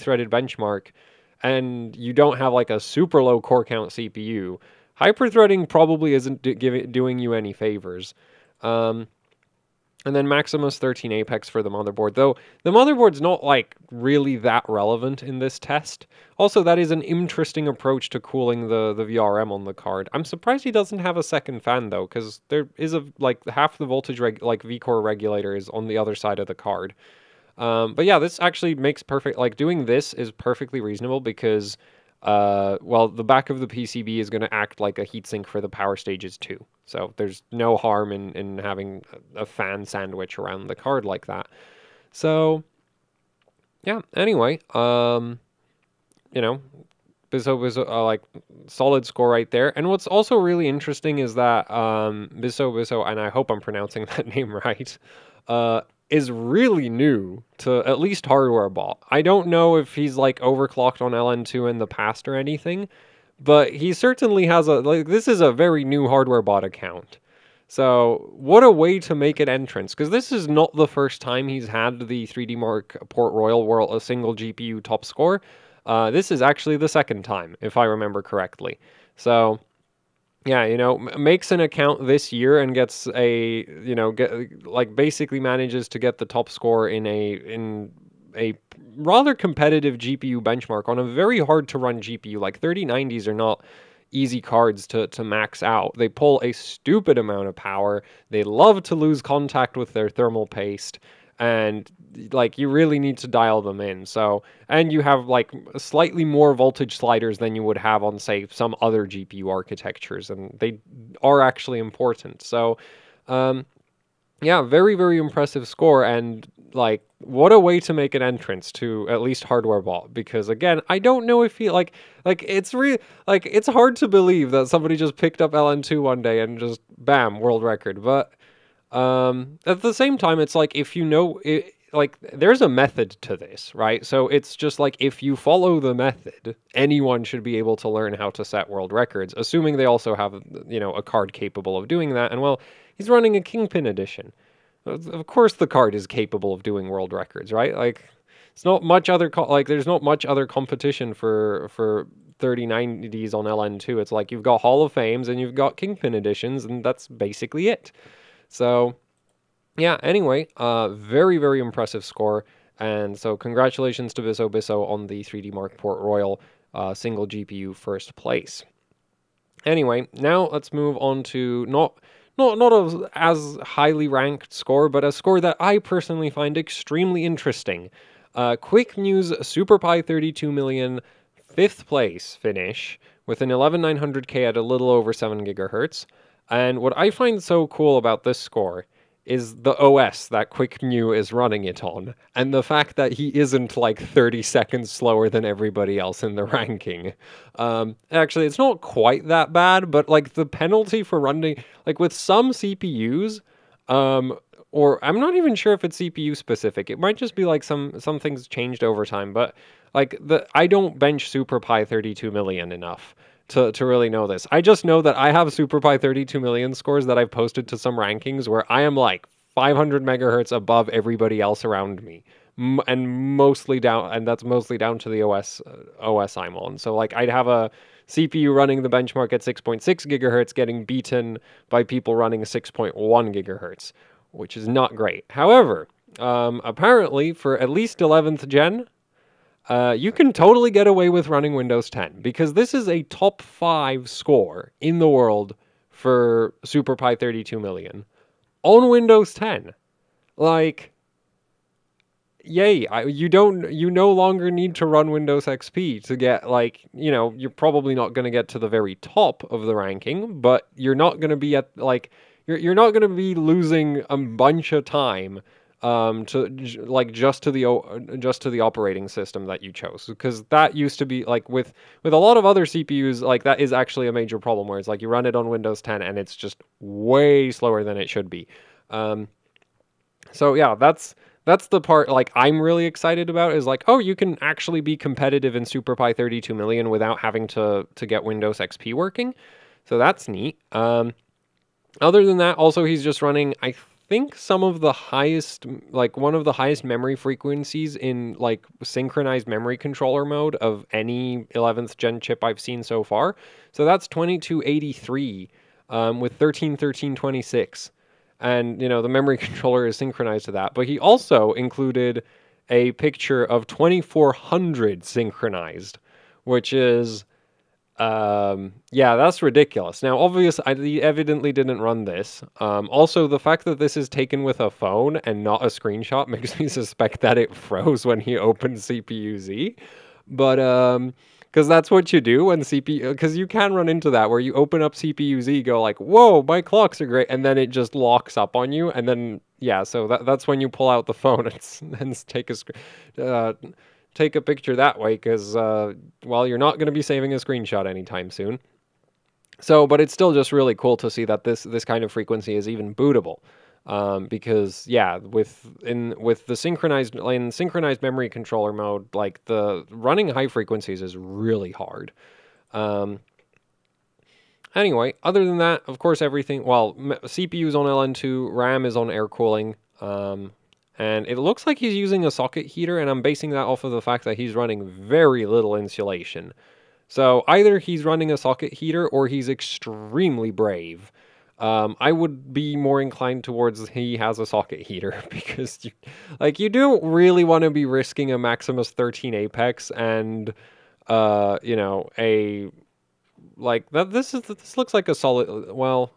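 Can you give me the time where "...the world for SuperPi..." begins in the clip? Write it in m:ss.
4:04.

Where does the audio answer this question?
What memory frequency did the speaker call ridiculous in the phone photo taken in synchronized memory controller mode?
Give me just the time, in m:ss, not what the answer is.
5:13.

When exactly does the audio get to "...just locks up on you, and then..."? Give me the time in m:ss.
5:37.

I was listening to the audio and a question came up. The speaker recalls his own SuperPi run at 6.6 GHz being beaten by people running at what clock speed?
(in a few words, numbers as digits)
6.1 GHz.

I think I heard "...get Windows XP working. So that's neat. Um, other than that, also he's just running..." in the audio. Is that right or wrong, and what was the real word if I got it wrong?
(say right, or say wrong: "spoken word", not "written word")
right.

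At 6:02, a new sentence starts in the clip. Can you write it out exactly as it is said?
Um, anyway, other than that, of course, everything well, CPU's on LN2, RAM is on air cooling.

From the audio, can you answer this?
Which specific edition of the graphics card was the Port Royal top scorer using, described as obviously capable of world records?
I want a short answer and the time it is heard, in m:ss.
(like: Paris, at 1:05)
Kingpin edition, at 2:23.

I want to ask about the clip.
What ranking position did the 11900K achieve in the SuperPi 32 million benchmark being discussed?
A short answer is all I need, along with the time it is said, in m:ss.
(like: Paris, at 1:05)
fifth place, at 3:01.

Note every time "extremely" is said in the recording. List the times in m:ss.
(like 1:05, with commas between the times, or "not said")
2:56, 6:19.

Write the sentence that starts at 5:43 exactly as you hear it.
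Uh, take a picture that way because, uh, well, you're not going to be saving a screenshot anytime soon.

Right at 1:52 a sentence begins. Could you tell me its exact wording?
So, um, yeah, very very impressive score and like what a way to make an entrance to at least hardware bot.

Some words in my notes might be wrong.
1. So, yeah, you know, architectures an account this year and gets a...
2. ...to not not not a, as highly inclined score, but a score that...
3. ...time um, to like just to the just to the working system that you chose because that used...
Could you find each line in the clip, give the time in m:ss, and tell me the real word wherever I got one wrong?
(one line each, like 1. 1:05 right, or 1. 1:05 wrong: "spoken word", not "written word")
1. 1:19 wrong: "makes", not "architectures"
2. 2:51 wrong: "ranked", not "inclined"
3. 4:24 wrong: "operating", not "working".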